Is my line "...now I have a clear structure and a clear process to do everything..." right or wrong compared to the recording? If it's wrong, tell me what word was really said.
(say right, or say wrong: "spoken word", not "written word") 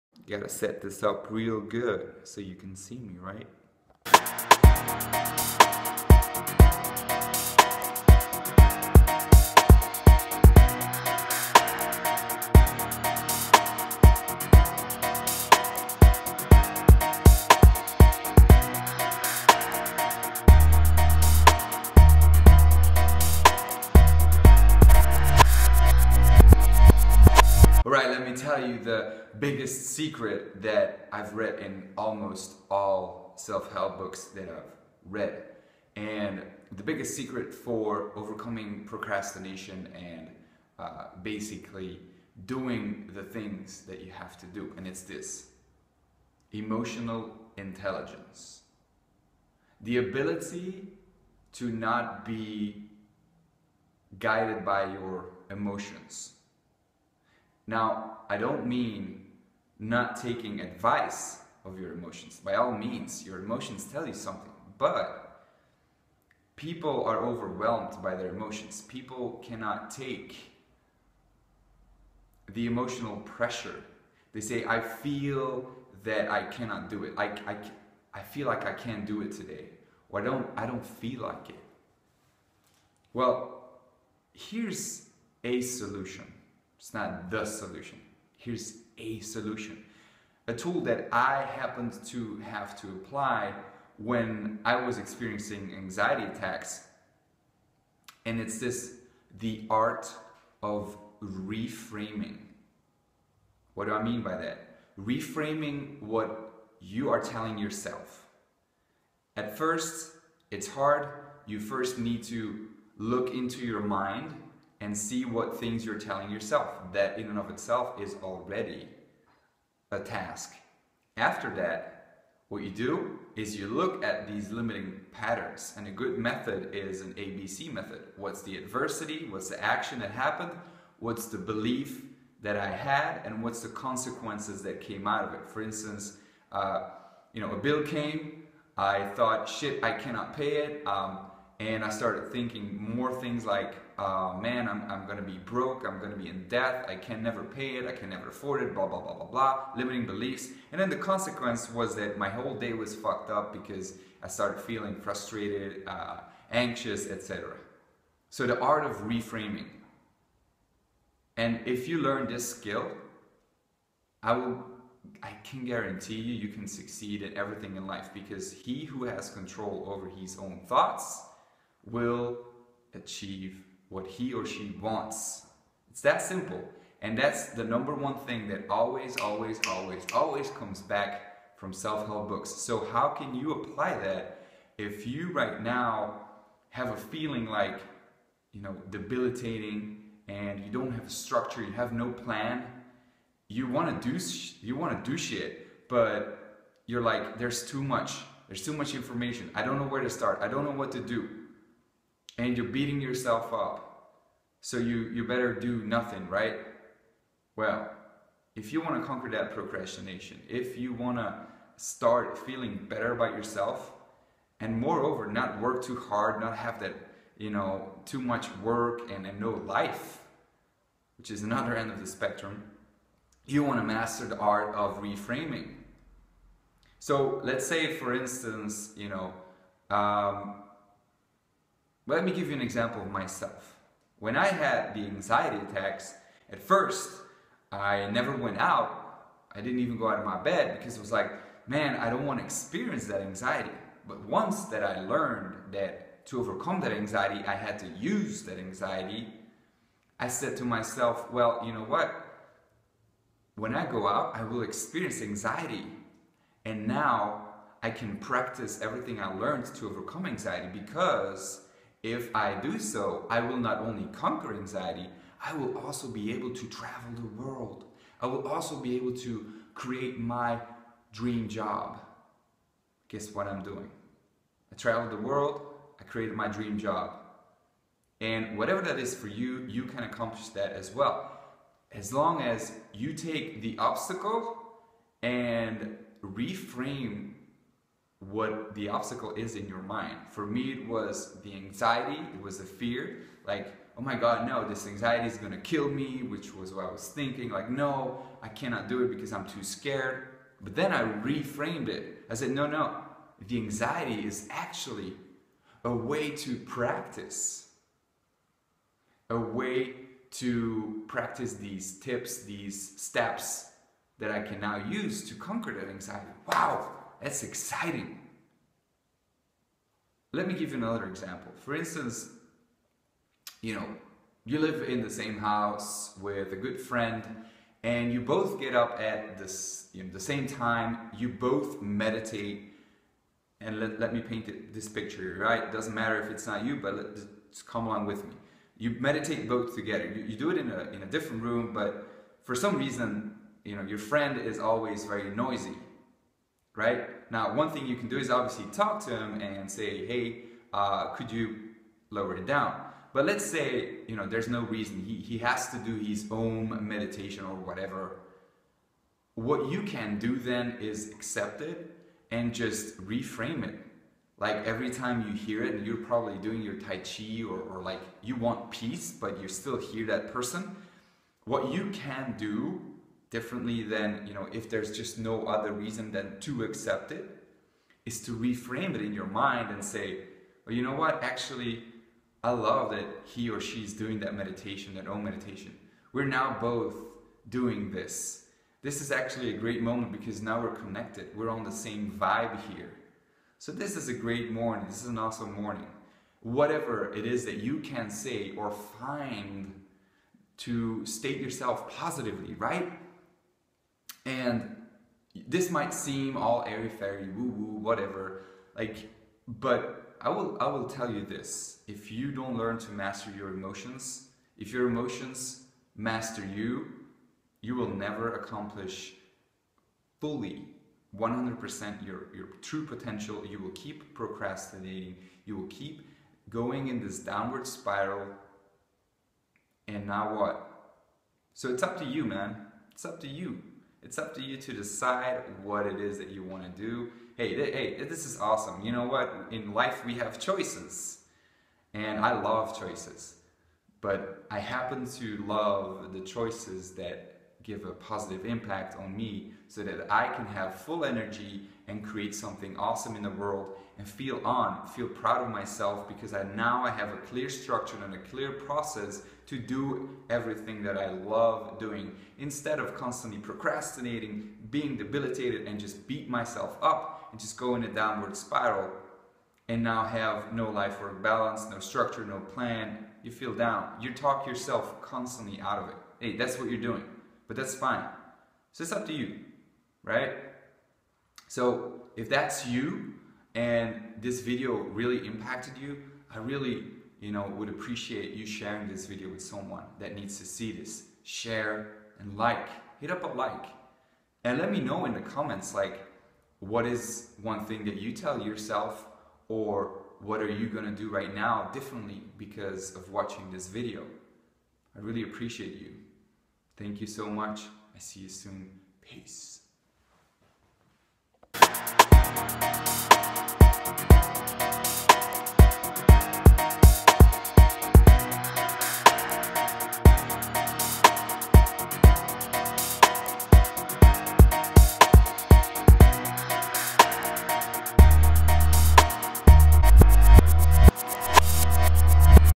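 right.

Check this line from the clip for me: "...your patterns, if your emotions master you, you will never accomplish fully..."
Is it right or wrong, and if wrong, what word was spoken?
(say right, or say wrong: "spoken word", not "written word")
wrong: "emotions", not "patterns".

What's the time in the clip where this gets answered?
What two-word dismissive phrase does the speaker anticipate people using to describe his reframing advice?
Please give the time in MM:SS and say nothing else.
06:46.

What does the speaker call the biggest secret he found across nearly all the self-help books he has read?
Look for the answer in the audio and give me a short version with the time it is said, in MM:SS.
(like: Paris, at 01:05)
Emotional intelligence, at 00:46.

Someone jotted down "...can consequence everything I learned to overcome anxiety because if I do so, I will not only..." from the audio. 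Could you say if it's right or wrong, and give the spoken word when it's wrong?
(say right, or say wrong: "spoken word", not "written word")
wrong: "practice", not "consequence".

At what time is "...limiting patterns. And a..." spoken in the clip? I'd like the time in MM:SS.
02:04.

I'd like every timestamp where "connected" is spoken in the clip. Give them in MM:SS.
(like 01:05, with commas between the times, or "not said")
06:30.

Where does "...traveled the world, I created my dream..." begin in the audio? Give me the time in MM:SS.
04:34.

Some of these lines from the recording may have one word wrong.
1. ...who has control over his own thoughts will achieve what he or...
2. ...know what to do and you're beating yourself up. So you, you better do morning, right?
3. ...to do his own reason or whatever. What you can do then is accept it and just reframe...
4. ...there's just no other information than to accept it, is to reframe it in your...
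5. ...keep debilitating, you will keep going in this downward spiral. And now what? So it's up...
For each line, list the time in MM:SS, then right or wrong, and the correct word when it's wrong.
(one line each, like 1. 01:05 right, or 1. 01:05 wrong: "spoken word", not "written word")
1. 02:48 right
2. 03:20 wrong: "nothing", not "morning"
3. 05:55 wrong: "meditation", not "reason"
4. 06:14 wrong: "reason", not "information"
5. 07:03 wrong: "procrastinating", not "debilitating".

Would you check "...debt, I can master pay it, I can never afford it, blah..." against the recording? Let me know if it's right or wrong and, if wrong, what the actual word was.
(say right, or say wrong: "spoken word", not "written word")
wrong: "never", not "master".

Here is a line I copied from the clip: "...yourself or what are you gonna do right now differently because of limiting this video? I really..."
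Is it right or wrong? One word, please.
wrong.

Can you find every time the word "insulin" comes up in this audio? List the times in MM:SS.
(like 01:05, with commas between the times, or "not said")
not said.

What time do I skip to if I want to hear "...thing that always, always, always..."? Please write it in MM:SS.
02:58.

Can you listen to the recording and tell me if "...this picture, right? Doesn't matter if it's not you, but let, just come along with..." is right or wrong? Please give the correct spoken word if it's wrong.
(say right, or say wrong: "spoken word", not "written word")
right.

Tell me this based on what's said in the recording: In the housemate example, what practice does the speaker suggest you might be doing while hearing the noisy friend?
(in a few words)
Tai Chi.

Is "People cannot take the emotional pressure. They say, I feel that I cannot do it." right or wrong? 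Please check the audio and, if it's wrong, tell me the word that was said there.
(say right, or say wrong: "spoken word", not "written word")
right.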